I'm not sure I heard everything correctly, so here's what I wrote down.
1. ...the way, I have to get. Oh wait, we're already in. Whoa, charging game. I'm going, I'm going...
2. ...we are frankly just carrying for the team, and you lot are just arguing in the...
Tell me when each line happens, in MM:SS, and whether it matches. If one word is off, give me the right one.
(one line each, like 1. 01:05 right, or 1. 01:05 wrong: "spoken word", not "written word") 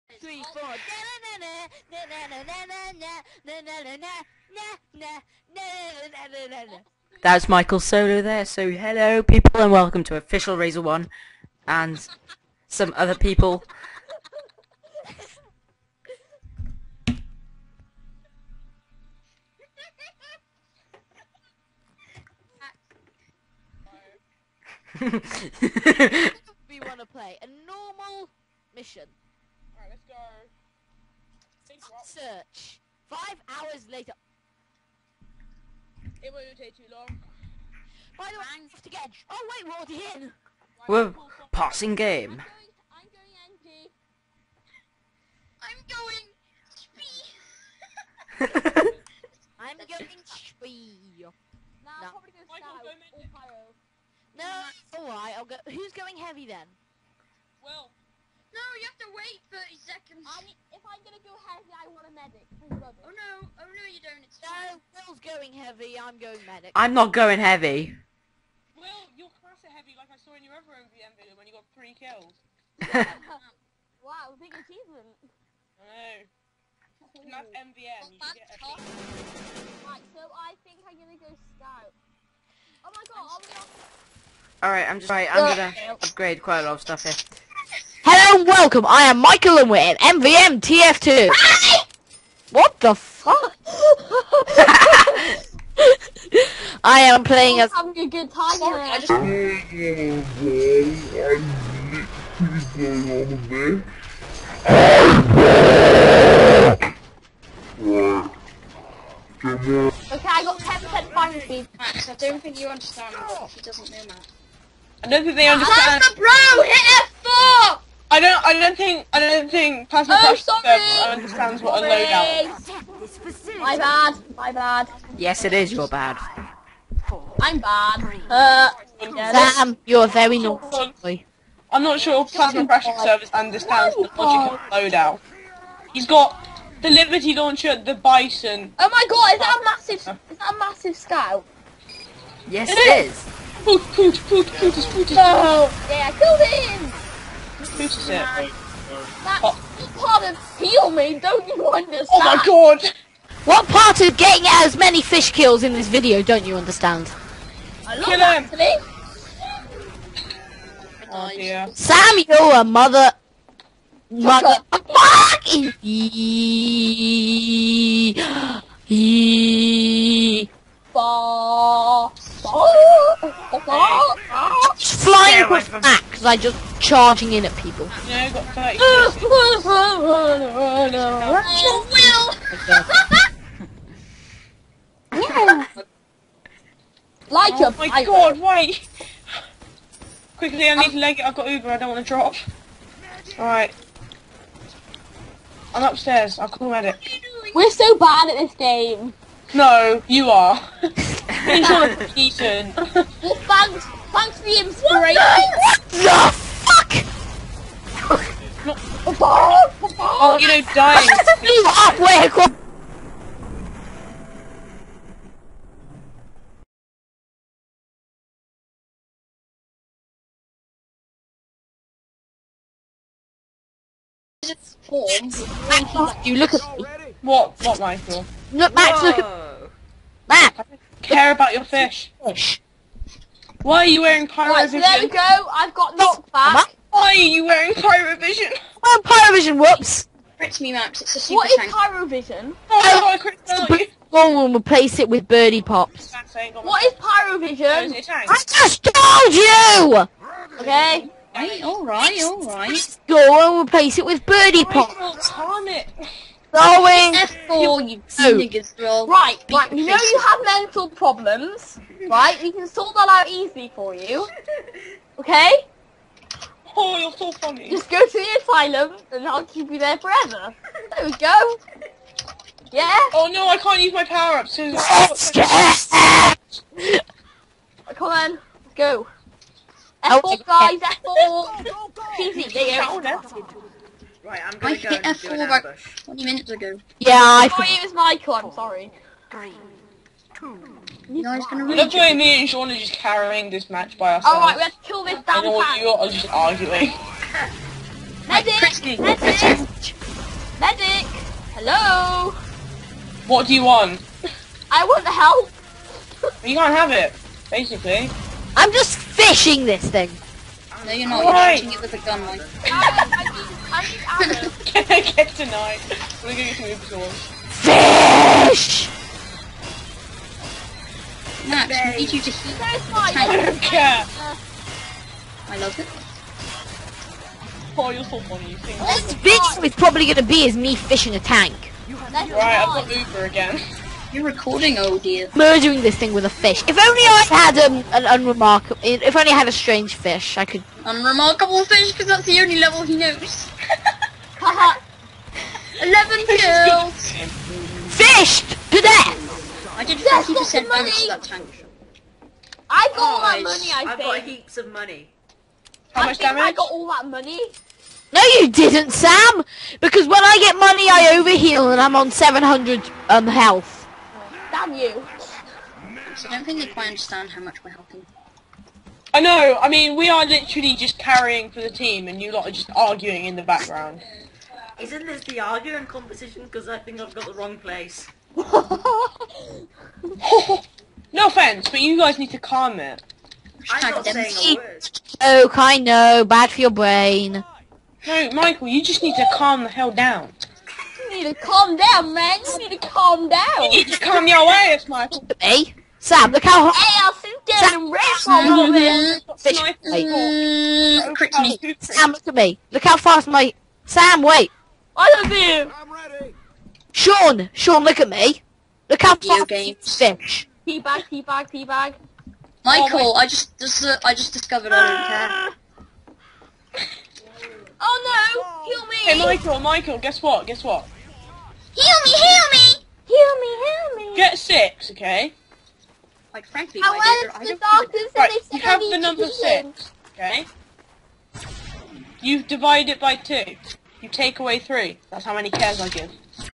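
1. 00:38 wrong: "passing", not "charging"
2. 06:09 wrong: "literally", not "frankly".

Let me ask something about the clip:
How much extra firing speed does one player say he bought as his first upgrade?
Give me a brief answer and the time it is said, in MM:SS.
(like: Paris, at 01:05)
10%, at 01:50.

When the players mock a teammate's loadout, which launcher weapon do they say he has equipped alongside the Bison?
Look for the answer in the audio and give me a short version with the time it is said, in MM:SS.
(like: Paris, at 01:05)
Liberty Launcher, at 02:16.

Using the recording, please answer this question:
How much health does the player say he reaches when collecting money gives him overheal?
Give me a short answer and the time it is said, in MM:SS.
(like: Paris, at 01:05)
700, at 06:02.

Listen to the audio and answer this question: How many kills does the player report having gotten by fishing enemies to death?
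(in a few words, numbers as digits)
11.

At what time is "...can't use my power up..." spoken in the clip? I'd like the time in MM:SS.
04:33.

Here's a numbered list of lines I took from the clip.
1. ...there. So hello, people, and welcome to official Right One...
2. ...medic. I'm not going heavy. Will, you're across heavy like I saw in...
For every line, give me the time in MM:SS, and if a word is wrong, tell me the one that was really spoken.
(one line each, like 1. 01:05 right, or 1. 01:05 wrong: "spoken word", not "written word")
1. 00:08 wrong: "Razor", not "Right"
2. 01:06 wrong: "class", not "across".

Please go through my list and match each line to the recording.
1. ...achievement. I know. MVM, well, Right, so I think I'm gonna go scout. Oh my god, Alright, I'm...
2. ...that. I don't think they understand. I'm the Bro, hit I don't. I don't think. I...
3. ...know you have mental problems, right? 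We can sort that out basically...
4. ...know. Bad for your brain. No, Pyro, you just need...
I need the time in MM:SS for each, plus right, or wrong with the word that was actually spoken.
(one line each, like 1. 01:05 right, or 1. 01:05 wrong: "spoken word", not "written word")
1. 01:14 right
2. 01:54 right
3. 04:19 wrong: "easily", not "basically"
4. 06:25 wrong: "Michael", not "Pyro".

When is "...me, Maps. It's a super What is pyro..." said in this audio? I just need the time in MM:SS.
04:00.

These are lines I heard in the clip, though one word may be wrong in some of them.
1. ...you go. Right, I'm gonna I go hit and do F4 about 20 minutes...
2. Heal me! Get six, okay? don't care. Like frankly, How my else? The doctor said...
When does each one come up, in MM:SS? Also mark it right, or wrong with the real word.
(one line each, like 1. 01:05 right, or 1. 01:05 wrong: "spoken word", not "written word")
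1. 04:42 right
2. 07:03 right.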